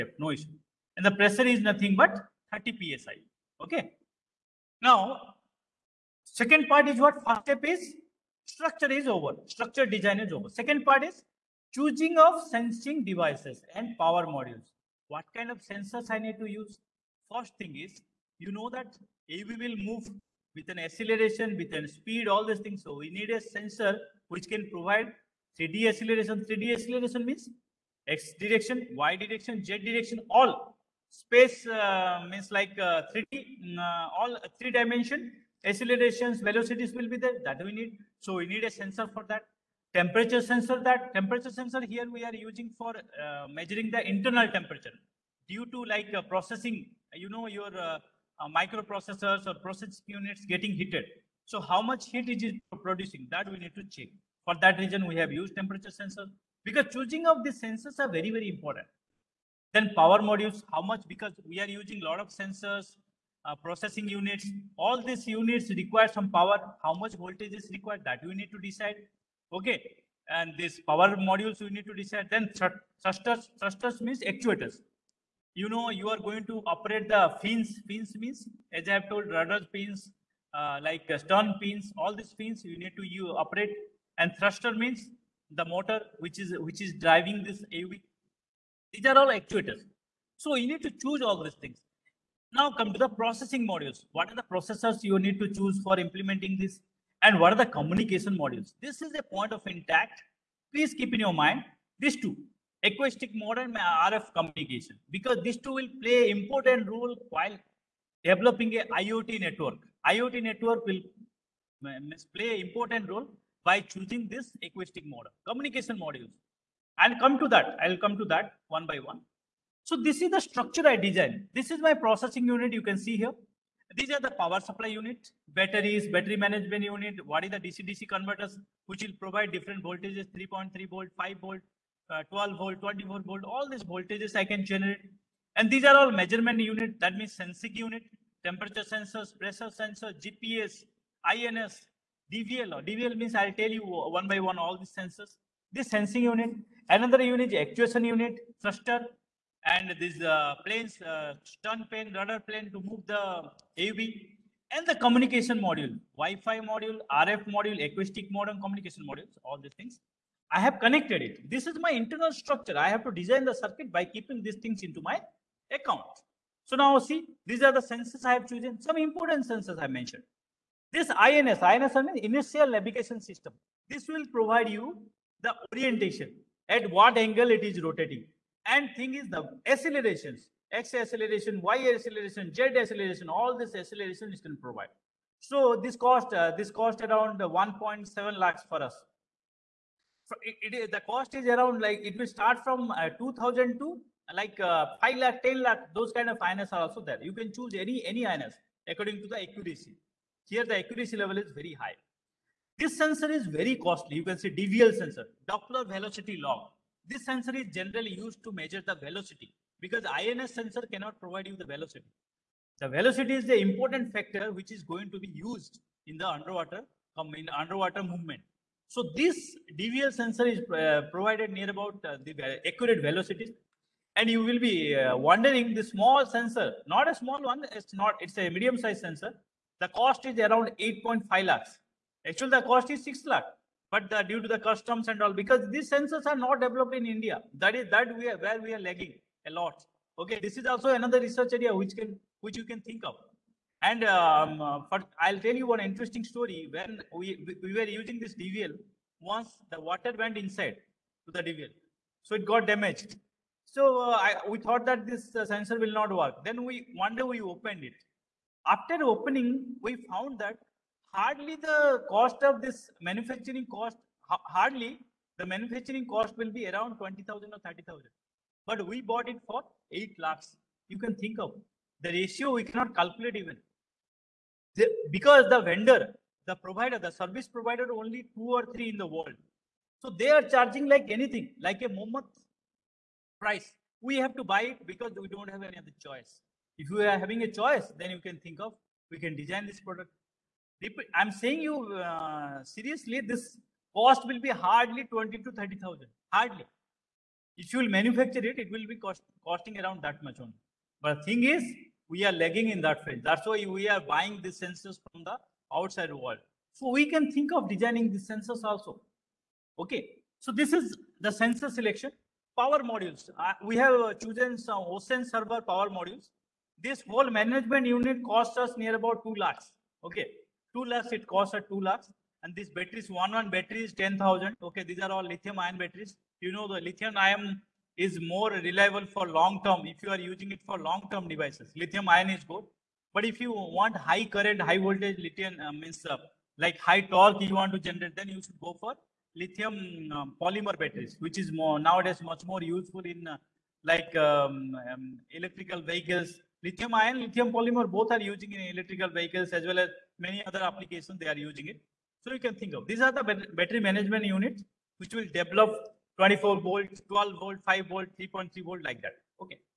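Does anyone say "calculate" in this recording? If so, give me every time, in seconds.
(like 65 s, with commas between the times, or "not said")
272 s.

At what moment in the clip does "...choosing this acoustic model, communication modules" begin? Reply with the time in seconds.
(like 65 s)
113 s.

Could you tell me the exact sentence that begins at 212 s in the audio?
The velocity is the important factor which is going to be used in the underwater um, in underwater movement.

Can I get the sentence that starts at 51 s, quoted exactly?
So how much heat it producing that we need to check.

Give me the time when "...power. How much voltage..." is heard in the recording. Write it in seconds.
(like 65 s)
66 s.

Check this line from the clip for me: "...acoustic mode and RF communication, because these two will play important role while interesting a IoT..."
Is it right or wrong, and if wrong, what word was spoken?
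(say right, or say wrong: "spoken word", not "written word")
wrong: "developing", not "interesting".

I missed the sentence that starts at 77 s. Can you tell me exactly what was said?
Fins means, as I have told, rudder pins, uh, like stern pins, all these pins you need to you operate.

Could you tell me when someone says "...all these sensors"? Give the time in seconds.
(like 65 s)
144 s.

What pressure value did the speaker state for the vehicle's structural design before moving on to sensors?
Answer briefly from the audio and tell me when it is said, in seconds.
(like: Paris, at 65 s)
30 PSI, at 2 s.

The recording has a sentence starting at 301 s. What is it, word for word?
But thing is, we are lagging in that field.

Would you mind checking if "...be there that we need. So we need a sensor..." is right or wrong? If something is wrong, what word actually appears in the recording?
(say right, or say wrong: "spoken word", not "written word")
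right.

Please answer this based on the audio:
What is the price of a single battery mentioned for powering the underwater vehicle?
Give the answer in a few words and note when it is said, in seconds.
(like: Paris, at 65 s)
10,000, at 323 s.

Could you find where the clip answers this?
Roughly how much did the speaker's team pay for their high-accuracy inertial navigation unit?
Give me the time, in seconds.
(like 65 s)
187 s.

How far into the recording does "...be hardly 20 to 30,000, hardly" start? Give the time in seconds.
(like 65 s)
294 s.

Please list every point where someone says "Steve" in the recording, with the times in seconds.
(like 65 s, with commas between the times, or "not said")
not said.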